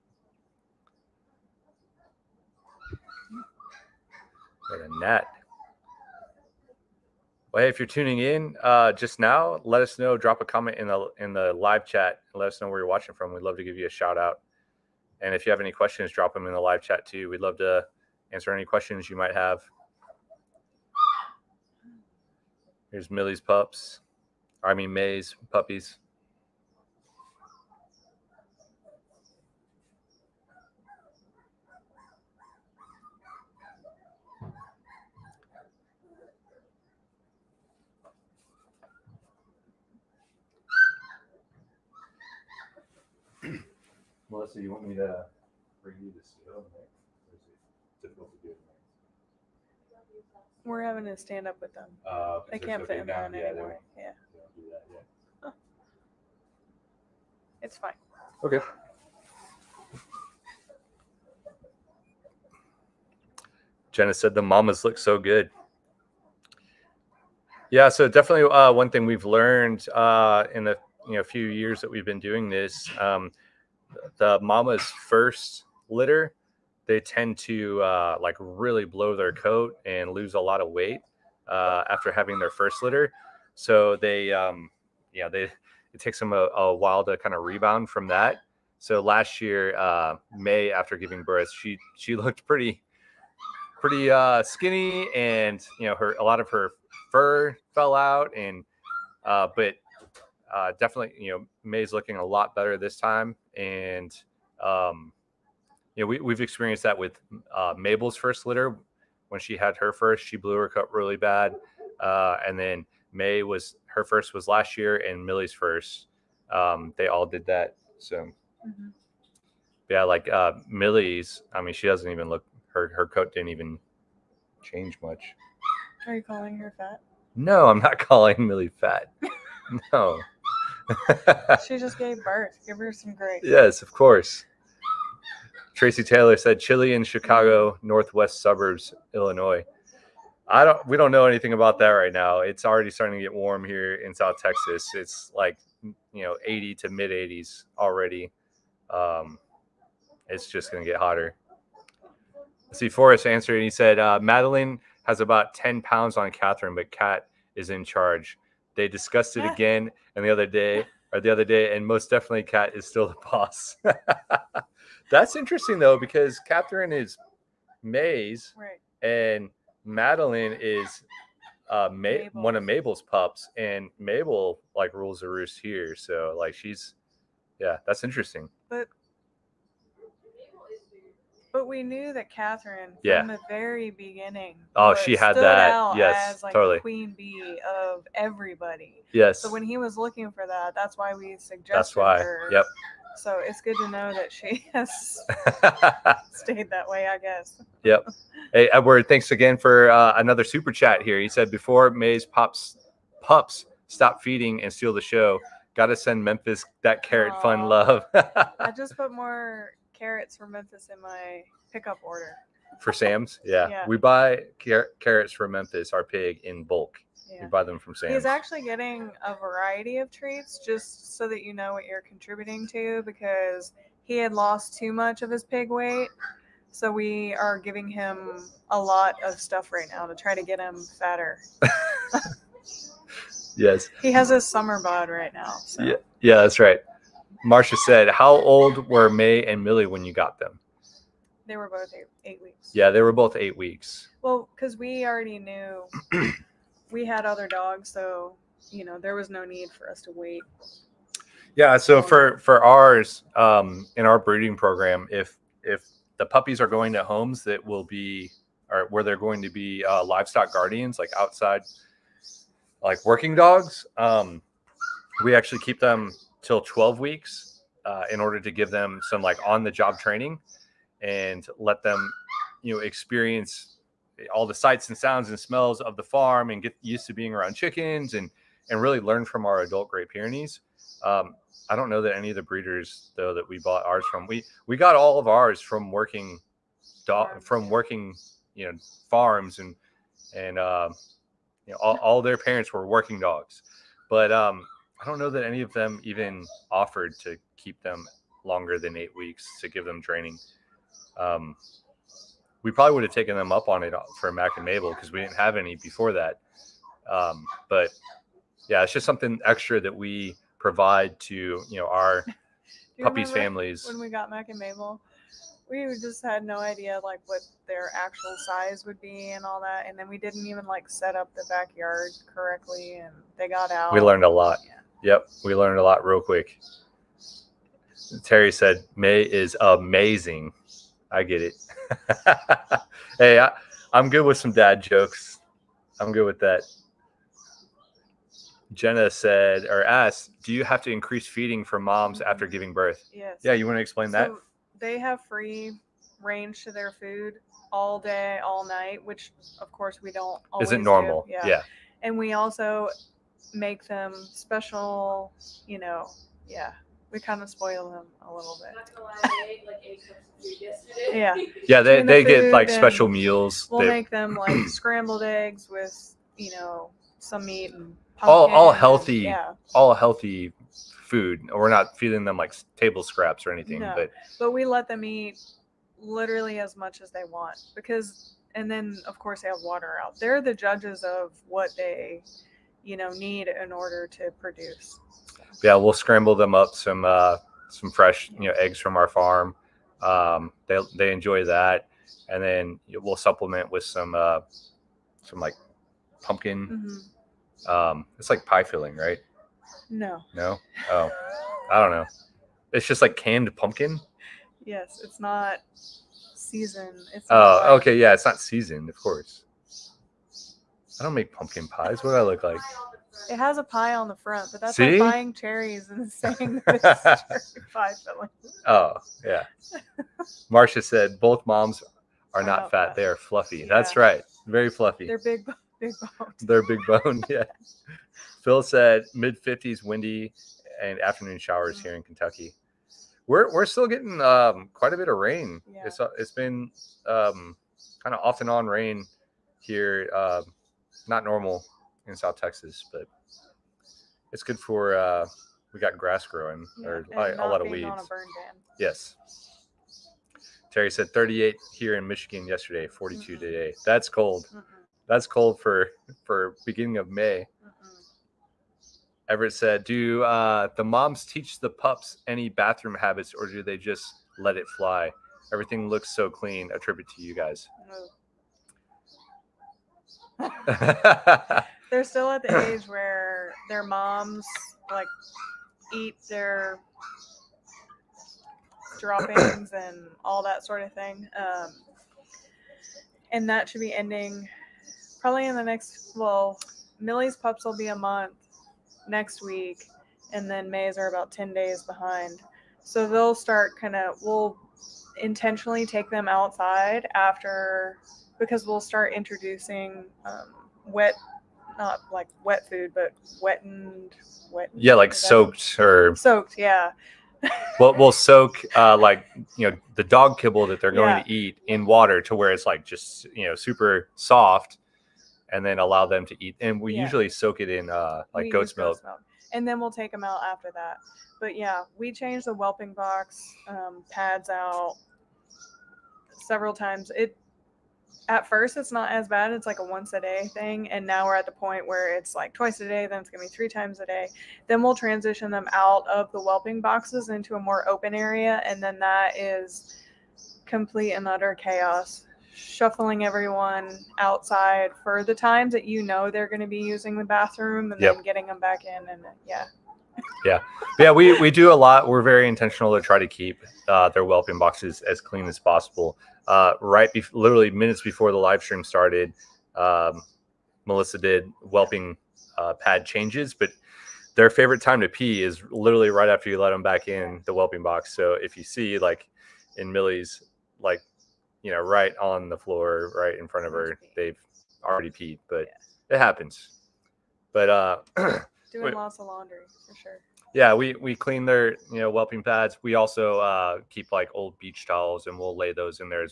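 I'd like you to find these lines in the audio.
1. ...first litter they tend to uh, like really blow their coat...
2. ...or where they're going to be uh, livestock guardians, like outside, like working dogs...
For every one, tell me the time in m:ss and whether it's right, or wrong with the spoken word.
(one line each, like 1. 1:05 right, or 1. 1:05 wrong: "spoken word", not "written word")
1. 1:14 right
2. 4:18 right.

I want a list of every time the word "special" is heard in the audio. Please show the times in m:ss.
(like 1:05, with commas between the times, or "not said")
5:54, 6:02.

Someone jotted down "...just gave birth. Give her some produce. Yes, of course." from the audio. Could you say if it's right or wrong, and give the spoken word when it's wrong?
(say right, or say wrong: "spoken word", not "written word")
wrong: "grace", not "produce".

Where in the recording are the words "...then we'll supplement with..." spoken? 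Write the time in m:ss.
6:32.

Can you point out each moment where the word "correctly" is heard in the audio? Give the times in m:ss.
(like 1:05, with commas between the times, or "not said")
5:22.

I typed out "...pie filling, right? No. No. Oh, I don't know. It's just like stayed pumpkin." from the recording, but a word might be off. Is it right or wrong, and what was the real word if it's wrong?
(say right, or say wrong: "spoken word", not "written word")
wrong: "canned", not "stayed".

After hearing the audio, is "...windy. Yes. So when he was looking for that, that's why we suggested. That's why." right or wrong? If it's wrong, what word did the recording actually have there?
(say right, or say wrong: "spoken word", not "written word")
wrong: "everybody", not "windy".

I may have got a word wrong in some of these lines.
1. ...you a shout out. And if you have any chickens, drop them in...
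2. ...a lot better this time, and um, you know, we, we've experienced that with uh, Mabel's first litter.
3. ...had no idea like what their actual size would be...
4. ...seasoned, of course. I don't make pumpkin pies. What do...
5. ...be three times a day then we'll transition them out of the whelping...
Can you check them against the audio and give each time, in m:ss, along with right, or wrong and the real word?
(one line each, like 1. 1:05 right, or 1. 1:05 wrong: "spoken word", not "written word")
1. 0:13 wrong: "questions", not "chickens"
2. 1:42 right
3. 5:16 right
4. 6:48 right
5. 8:53 right.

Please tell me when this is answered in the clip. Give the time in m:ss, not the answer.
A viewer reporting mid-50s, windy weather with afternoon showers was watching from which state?
7:12.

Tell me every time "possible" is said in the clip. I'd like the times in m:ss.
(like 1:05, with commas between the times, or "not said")
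9:15.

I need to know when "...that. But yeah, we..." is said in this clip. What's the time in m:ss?
8:40.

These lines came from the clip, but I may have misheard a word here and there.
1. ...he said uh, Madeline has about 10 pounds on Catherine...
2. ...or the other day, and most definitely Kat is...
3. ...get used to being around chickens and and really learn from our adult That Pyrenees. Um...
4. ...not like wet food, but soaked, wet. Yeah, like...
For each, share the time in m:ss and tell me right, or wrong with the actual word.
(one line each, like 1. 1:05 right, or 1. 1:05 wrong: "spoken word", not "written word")
1. 2:33 right
2. 2:41 right
3. 4:36 wrong: "Great", not "That"
4. 8:21 wrong: "wetened", not "soaked".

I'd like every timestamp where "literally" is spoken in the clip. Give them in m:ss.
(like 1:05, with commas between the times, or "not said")
6:15, 9:17, 9:25.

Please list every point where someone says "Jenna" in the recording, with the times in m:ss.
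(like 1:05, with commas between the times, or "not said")
1:03, 5:38.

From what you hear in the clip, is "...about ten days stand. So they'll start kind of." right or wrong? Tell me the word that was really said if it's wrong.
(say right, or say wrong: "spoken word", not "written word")
wrong: "behind", not "stand".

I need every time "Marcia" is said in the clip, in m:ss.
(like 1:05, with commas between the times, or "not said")
3:57, 7:00.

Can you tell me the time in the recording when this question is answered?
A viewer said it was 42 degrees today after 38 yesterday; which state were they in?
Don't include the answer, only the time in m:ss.
7:32.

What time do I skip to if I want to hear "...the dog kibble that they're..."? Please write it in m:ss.
8:29.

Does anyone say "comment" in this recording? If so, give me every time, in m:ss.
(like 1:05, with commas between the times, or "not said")
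0:10.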